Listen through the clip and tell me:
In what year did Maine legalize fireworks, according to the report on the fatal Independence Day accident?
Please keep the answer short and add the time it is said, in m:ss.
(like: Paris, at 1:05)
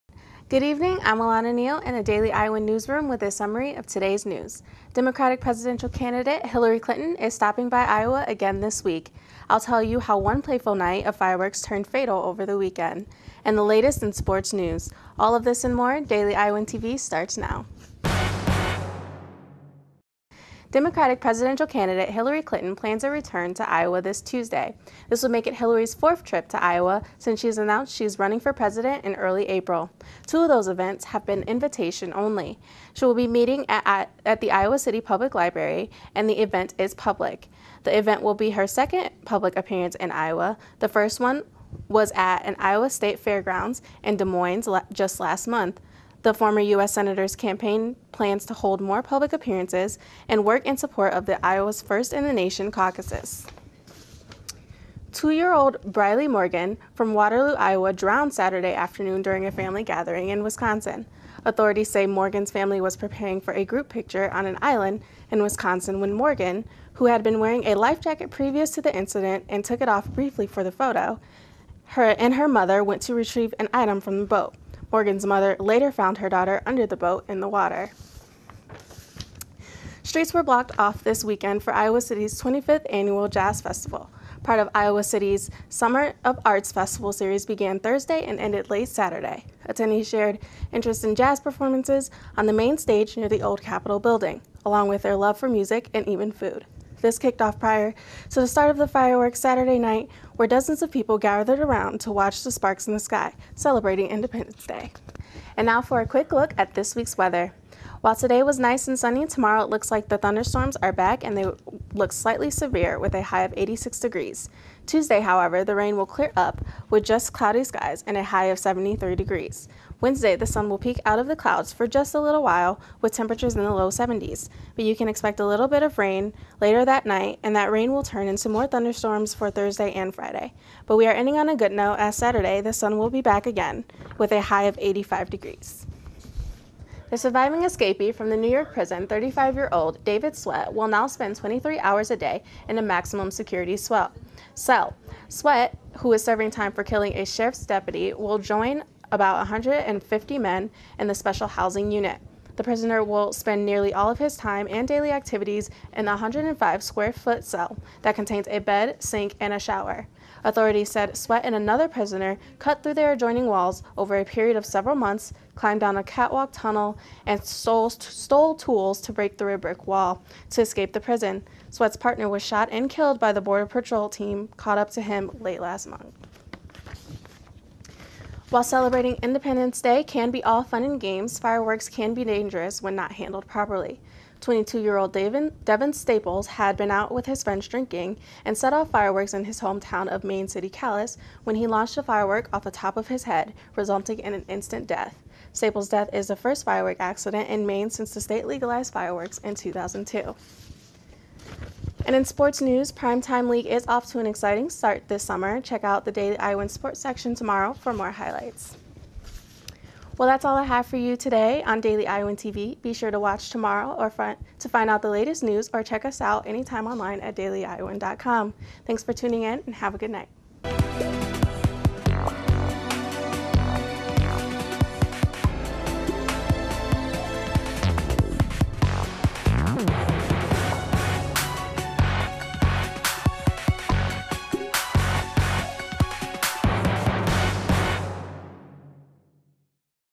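2002, at 3:19.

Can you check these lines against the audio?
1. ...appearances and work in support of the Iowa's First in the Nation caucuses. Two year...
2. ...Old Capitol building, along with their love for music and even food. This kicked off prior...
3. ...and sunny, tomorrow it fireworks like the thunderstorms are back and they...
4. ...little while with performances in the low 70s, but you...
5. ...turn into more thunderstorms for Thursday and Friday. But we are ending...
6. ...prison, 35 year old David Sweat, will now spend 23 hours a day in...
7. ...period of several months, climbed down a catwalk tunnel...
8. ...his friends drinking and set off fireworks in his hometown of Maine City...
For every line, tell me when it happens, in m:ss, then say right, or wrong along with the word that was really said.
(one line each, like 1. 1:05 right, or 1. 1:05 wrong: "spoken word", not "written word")
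1. 0:49 right
2. 1:33 right
3. 1:48 wrong: "looks", not "fireworks"
4. 2:02 wrong: "temperatures", not "performances"
5. 2:08 right
6. 2:18 right
7. 2:44 right
8. 3:07 right.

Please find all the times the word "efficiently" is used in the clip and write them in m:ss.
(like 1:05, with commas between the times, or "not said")
not said.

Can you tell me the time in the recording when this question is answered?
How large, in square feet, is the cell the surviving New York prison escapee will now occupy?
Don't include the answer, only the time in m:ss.
2:36.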